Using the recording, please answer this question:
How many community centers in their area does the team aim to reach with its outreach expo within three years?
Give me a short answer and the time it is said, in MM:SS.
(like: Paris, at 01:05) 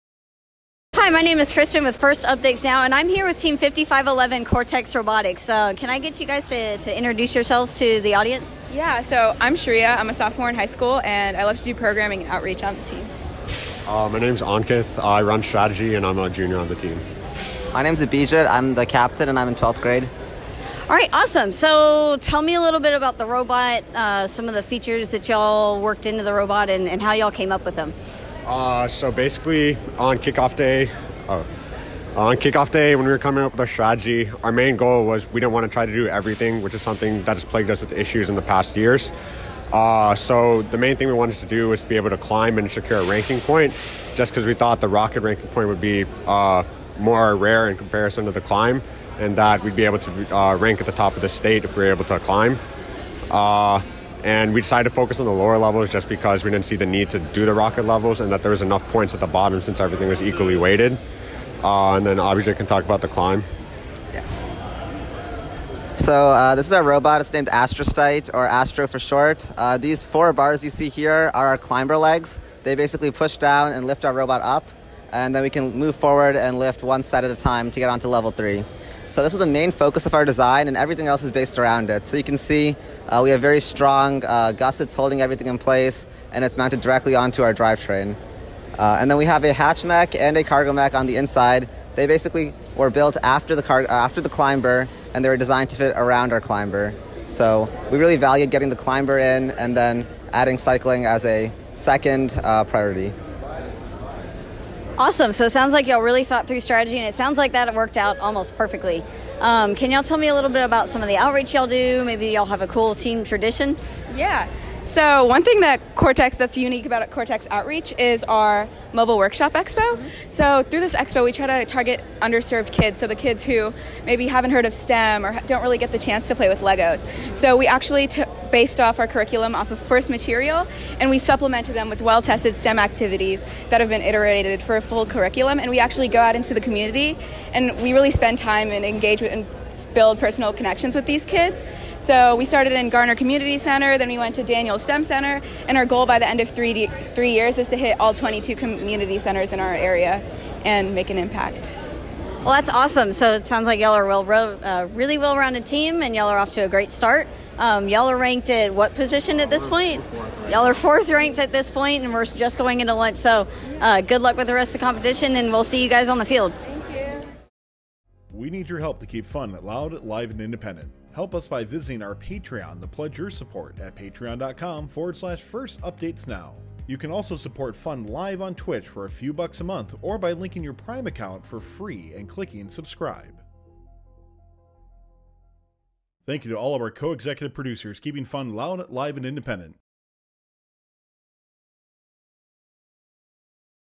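22, at 02:28.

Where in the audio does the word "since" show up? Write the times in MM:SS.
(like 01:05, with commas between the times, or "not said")
00:59.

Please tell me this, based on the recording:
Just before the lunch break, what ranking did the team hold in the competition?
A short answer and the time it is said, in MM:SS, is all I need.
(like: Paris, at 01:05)
4th, at 02:40.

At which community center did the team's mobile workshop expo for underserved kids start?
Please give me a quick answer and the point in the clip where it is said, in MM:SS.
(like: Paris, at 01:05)
Garner Community Center, at 02:22.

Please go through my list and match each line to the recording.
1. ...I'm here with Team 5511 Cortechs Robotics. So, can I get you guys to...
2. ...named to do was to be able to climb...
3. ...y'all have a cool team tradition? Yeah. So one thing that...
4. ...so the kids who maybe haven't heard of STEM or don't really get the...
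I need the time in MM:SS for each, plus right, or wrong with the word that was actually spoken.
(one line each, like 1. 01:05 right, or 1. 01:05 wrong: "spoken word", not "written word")
1. 00:02 right
2. 00:41 wrong: "wanted", not "named"
3. 01:52 right
4. 02:02 right.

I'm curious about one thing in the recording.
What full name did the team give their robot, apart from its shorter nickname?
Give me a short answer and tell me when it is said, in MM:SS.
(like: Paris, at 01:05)
Astrostite, at 01:07.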